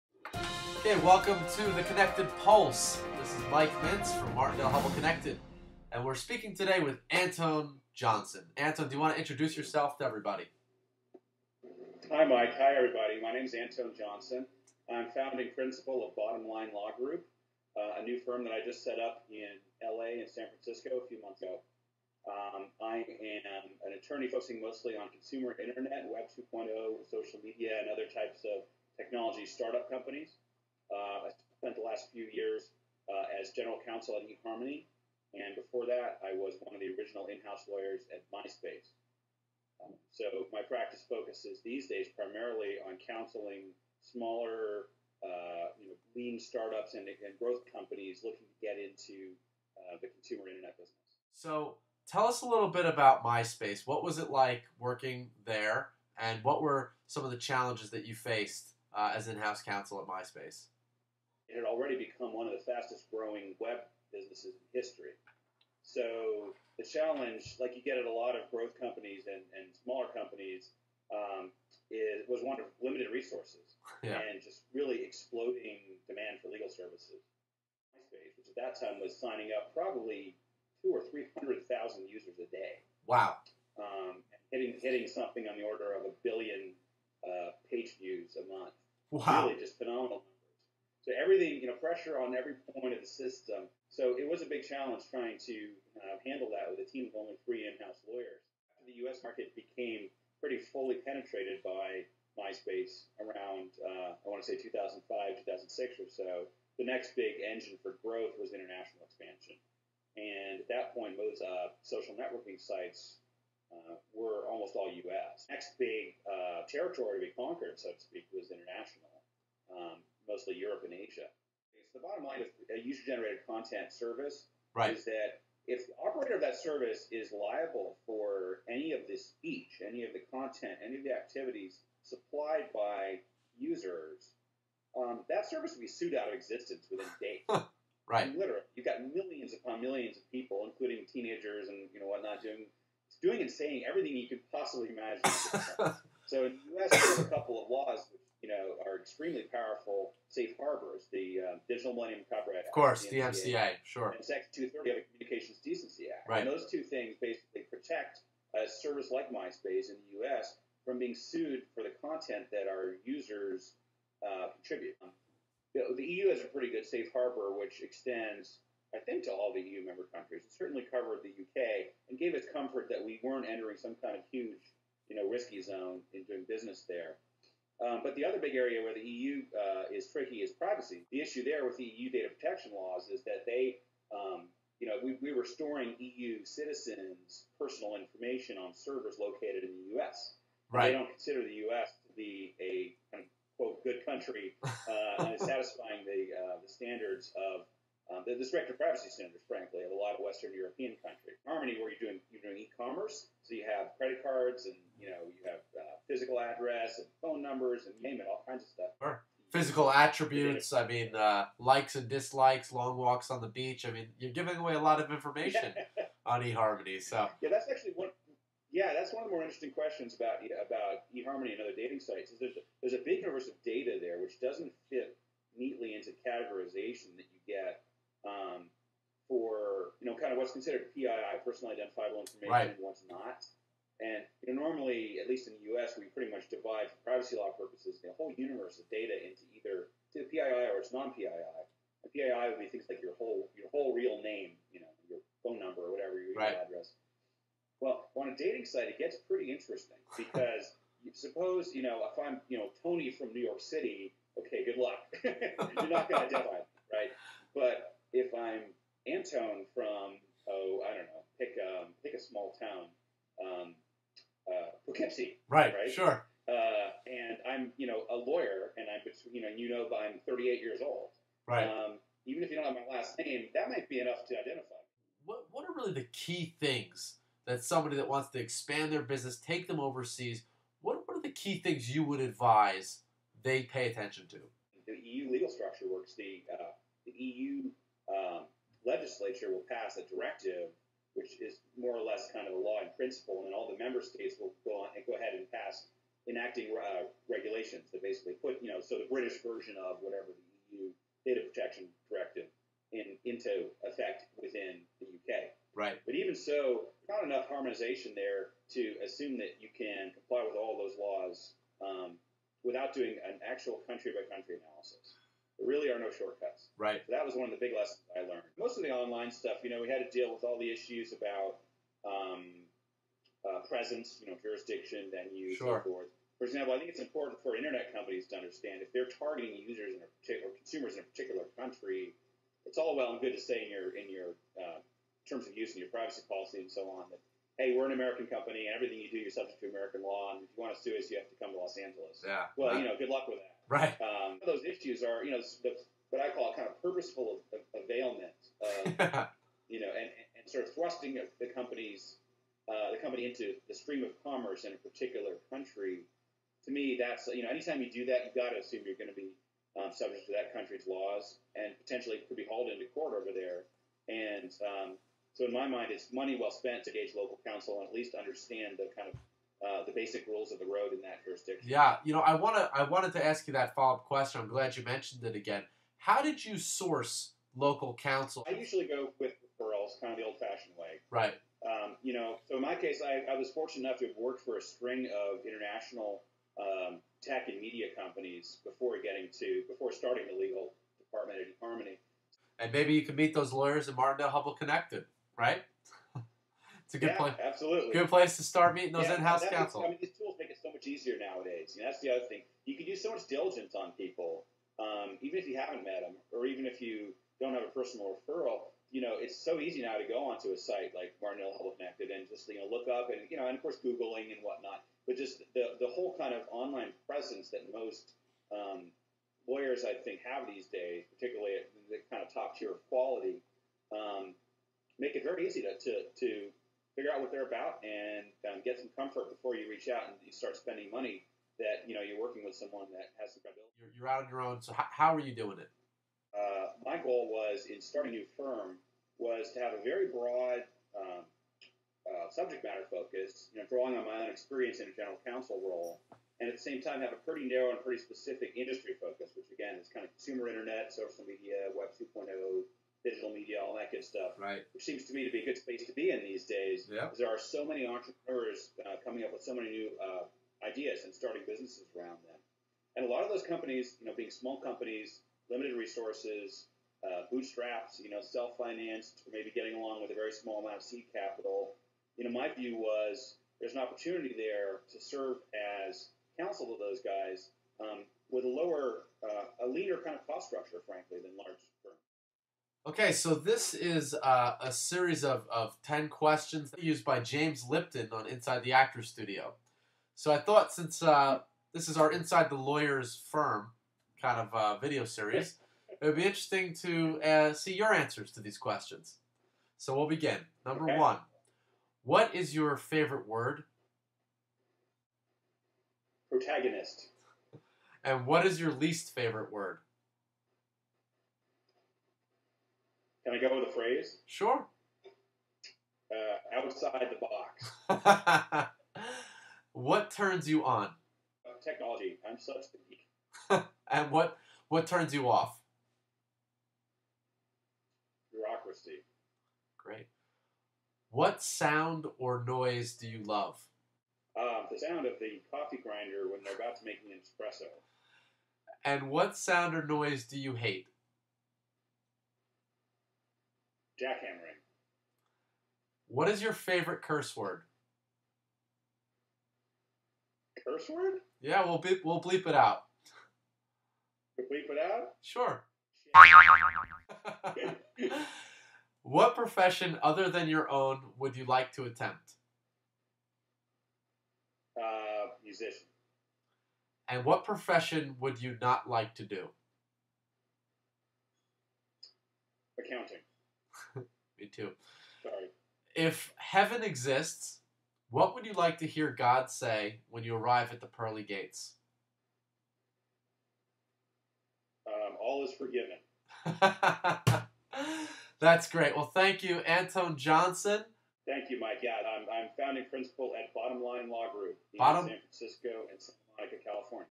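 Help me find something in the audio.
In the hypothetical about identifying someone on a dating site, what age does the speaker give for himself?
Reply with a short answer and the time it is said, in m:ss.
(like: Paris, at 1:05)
38, at 4:30.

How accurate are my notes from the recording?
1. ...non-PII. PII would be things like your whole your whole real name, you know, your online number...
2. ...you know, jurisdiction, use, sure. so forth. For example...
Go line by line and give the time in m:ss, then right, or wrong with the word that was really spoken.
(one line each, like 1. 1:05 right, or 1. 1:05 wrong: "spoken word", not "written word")
1. 4:00 wrong: "phone", not "online"
2. 5:24 right.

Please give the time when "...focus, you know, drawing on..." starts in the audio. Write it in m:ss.
7:22.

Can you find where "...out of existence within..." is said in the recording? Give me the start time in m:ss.
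2:16.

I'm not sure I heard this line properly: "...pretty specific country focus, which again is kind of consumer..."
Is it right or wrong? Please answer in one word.
wrong.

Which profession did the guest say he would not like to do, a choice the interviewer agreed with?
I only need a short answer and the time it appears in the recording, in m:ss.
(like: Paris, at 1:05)
Accounting, at 9:32.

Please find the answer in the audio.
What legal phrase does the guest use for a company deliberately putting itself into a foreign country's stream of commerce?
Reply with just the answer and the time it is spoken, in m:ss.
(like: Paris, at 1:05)
purposeful availment, at 5:46.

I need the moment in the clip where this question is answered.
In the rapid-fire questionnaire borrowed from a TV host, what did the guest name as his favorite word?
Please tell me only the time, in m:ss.
8:26.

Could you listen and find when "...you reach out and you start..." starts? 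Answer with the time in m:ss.
7:09.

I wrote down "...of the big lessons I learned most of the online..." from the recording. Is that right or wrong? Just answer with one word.
right.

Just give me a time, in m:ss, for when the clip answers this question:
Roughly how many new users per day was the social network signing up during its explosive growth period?
1:20.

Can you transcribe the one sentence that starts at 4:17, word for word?
But if I'm Antone from oh I don't know, pick um, pick a small town Right.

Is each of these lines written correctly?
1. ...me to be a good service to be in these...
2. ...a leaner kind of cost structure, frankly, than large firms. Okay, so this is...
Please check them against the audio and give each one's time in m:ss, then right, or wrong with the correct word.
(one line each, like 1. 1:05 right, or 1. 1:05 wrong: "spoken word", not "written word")
1. 7:35 wrong: "space", not "service"
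2. 7:59 right.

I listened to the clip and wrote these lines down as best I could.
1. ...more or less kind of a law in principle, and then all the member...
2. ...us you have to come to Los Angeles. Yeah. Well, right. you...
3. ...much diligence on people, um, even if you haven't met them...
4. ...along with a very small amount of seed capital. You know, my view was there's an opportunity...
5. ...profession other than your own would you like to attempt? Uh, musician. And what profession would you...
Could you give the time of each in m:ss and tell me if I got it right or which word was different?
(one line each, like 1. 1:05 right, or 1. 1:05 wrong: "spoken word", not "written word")
1. 4:51 right
2. 5:40 right
3. 6:43 right
4. 7:49 right
5. 9:19 right.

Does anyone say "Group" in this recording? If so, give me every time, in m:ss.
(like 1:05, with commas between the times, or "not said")
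0:16, 9:54.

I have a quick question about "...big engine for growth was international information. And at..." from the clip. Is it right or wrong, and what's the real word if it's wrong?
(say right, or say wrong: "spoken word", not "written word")
wrong: "expansion", not "information".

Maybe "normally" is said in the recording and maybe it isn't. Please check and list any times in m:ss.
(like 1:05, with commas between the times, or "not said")
3:54.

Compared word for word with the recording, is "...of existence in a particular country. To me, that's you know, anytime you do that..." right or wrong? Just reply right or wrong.
wrong.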